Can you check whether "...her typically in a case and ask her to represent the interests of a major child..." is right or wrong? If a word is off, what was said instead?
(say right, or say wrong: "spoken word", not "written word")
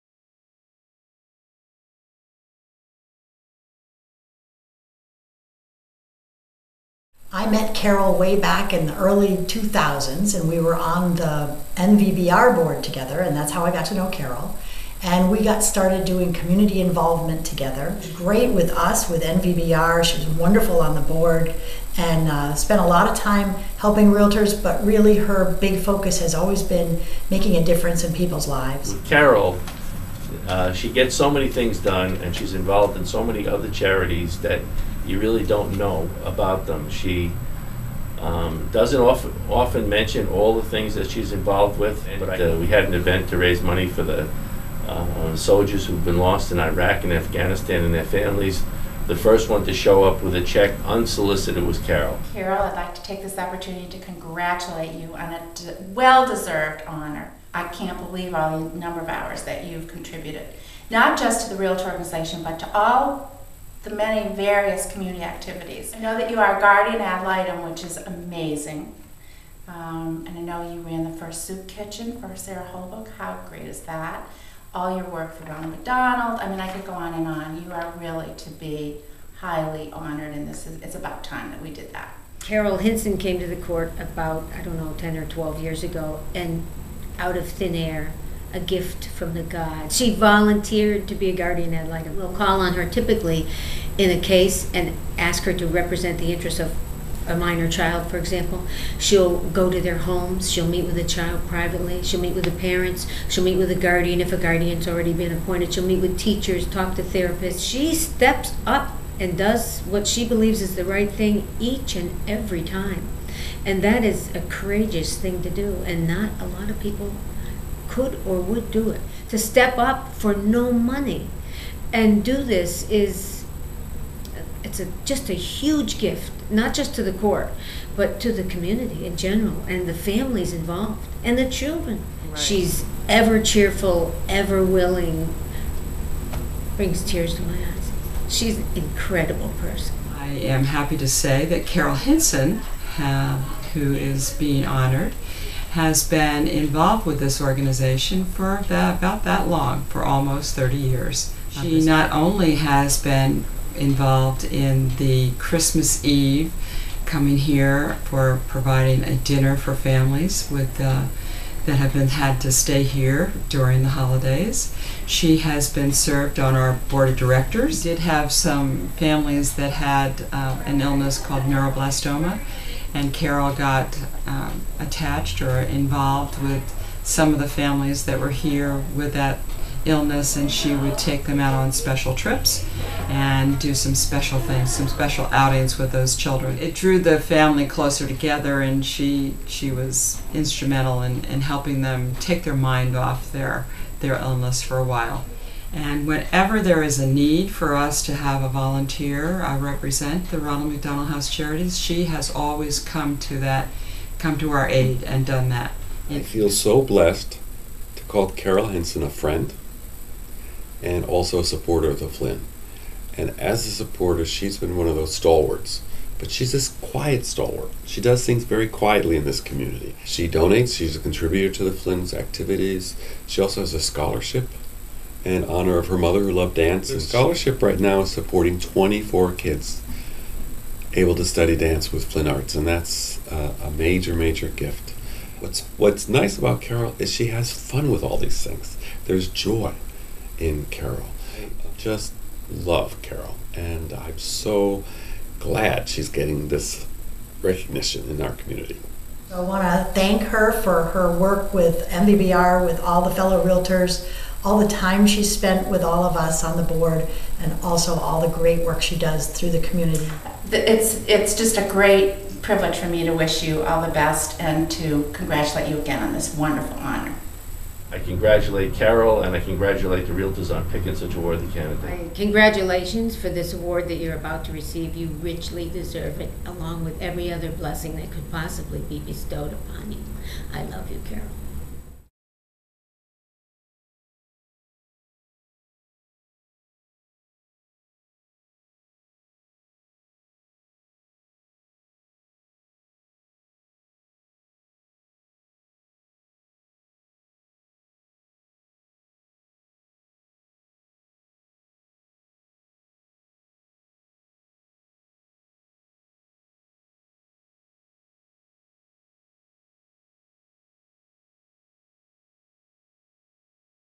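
wrong: "minor", not "major".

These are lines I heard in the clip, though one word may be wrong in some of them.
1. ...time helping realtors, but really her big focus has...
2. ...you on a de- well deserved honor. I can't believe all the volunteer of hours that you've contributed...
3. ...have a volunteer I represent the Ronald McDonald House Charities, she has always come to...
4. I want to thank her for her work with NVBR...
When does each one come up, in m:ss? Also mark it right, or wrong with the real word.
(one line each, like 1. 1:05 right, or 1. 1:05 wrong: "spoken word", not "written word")
1. 0:23 right
2. 0:54 wrong: "number", not "volunteer"
3. 3:18 right
4. 4:09 right.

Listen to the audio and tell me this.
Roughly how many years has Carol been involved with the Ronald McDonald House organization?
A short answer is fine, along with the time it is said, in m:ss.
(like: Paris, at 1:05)
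almost 30 years, at 2:30.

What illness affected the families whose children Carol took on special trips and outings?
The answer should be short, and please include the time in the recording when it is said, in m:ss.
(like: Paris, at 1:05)
neuroblastoma, at 2:51.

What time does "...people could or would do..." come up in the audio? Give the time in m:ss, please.
1:56.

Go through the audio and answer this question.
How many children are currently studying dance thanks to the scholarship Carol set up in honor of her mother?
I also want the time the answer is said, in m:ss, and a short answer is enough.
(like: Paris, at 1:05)
24, at 3:48.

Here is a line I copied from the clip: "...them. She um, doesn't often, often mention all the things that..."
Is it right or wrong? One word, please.
right.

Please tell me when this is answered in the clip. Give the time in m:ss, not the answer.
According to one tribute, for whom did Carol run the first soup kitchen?
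1:12.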